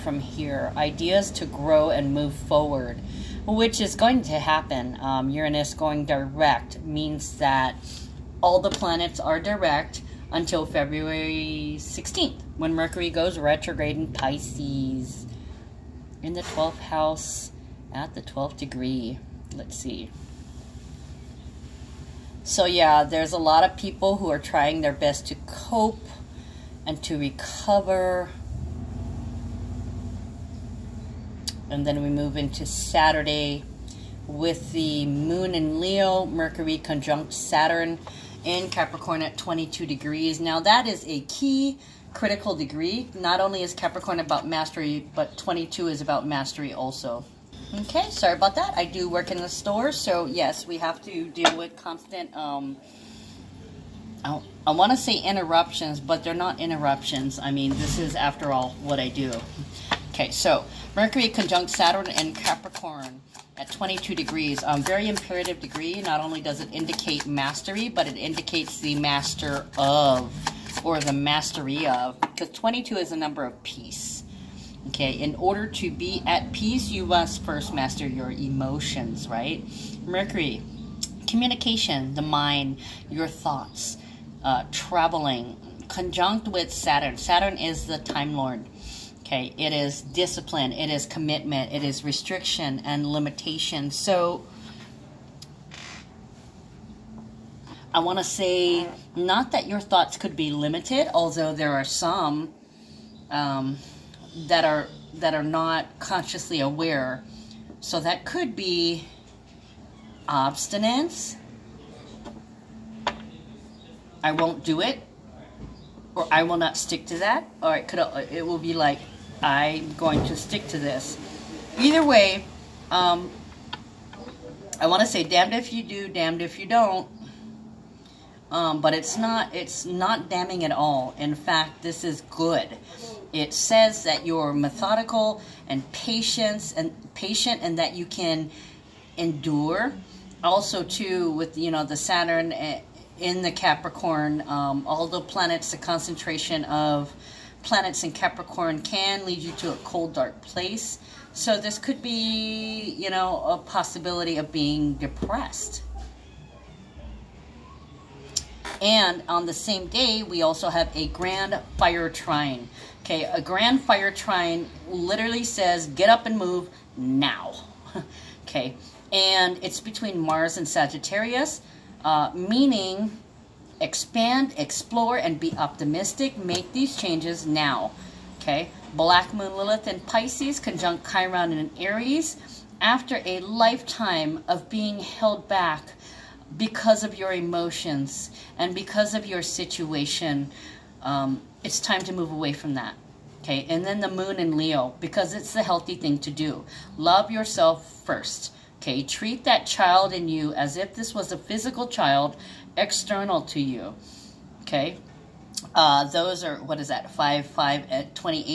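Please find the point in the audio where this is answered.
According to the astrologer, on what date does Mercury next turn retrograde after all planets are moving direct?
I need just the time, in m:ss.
0:10.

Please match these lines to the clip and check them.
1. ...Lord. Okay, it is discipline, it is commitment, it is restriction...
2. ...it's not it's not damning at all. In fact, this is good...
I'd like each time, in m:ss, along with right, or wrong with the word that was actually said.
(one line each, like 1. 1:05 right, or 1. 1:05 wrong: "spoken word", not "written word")
1. 1:28 right
2. 2:08 right.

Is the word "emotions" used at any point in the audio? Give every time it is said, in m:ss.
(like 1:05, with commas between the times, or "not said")
1:18, 3:07.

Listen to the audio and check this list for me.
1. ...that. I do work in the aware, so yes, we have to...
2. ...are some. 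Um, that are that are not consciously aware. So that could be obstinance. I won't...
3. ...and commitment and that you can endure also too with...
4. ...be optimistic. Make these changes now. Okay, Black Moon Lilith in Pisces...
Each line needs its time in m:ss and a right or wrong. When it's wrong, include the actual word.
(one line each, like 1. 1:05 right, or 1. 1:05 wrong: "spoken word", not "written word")
1. 0:48 wrong: "store", not "aware"
2. 1:41 right
3. 2:16 wrong: "patient", not "commitment"
4. 2:55 right.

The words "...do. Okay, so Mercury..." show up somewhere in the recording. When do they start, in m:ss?
0:59.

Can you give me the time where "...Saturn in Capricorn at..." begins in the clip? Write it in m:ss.
0:37.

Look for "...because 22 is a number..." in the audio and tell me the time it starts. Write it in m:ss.
1:12.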